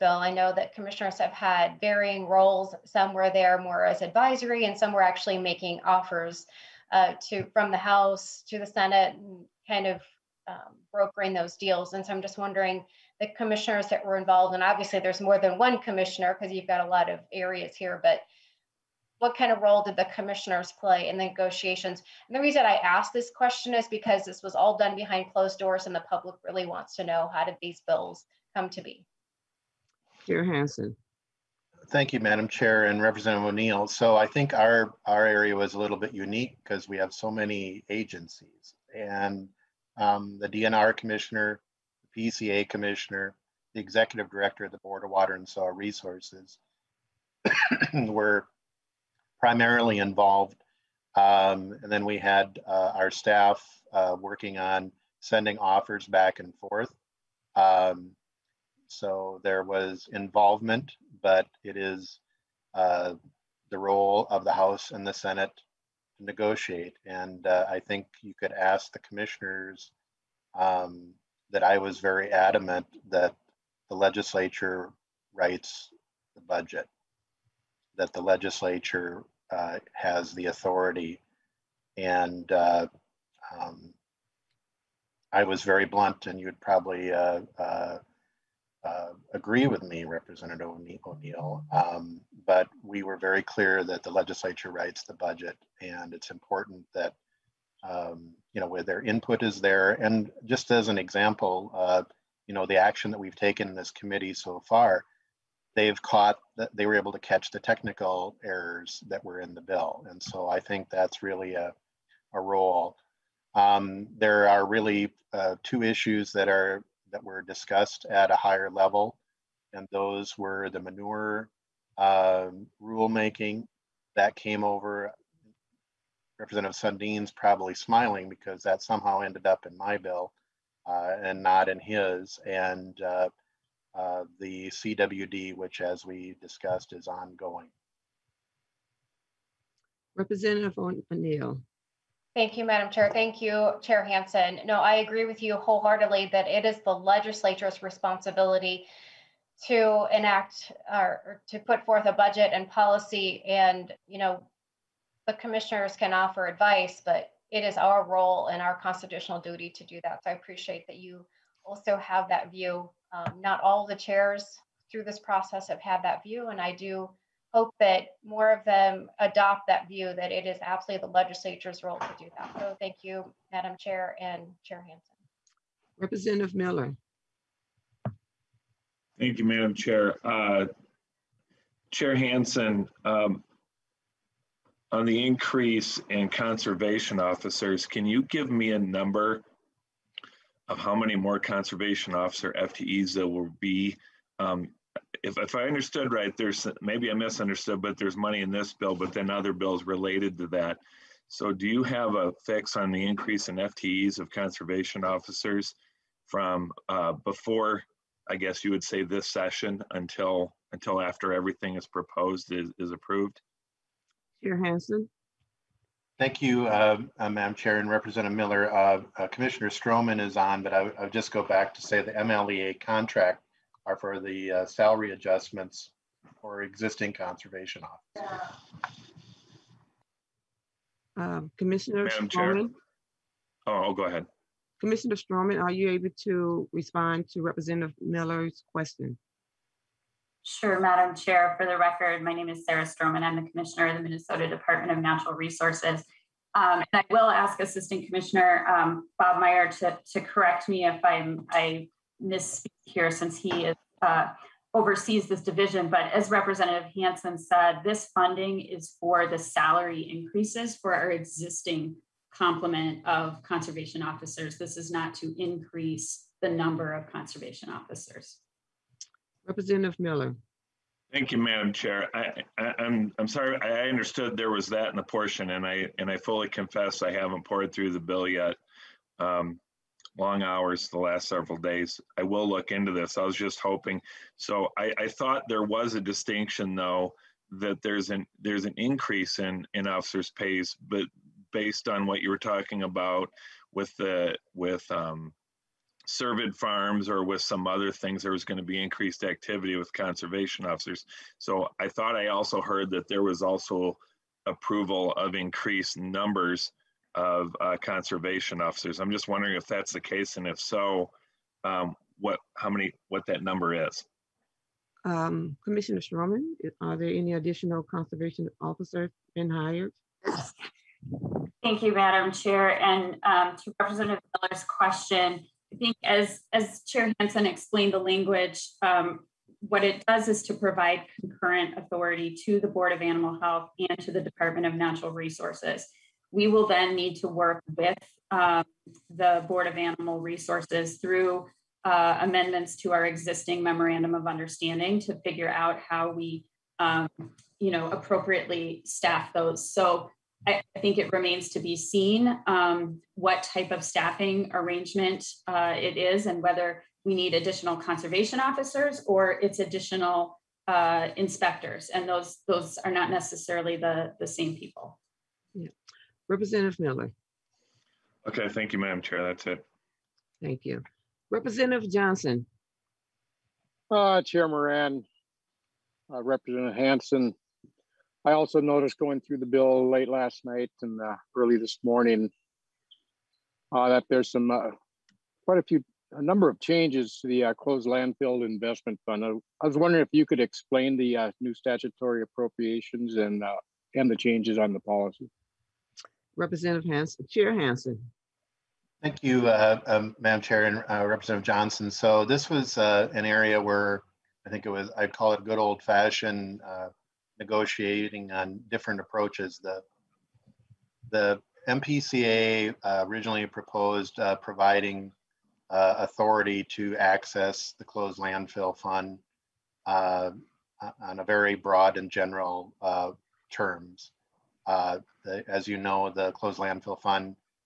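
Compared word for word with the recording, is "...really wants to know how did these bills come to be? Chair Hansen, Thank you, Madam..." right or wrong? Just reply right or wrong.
right.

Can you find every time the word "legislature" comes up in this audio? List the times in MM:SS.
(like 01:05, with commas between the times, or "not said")
01:13, 01:18, 01:34, 02:26, 02:51.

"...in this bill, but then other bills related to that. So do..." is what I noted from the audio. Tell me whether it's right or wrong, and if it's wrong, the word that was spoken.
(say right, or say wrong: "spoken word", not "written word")
right.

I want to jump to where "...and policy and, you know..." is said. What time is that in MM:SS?
02:32.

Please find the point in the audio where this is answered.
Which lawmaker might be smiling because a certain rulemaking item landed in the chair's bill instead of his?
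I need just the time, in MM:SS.
02:06.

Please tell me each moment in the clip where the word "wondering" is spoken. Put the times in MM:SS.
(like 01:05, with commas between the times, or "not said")
00:12, 05:09, 06:29.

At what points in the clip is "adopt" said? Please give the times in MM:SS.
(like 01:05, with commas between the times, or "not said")
02:49.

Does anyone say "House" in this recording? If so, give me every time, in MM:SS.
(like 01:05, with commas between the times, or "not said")
00:07, 01:04.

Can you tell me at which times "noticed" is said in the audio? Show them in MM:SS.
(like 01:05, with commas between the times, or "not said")
06:18.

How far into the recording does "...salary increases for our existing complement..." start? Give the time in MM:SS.
04:19.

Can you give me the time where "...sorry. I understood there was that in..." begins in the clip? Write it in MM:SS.
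04:33.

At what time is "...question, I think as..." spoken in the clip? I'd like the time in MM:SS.
05:24.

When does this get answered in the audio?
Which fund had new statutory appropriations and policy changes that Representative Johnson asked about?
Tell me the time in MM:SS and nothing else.
06:27.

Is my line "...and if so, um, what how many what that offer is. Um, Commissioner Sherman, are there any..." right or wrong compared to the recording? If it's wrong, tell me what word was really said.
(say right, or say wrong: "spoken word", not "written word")
wrong: "number", not "offer".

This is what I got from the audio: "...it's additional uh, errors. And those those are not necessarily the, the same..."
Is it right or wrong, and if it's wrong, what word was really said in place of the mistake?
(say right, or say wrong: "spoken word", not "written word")
wrong: "inspectors", not "errors".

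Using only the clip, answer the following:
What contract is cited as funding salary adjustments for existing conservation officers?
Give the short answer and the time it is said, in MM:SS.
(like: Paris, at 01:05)
MLEA contract, at 03:42.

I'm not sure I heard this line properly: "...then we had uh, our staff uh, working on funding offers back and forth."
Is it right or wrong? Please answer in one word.
wrong.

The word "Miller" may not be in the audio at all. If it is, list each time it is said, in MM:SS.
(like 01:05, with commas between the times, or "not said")
02:56, 03:38, 03:58, 04:29, 05:24, 06:06.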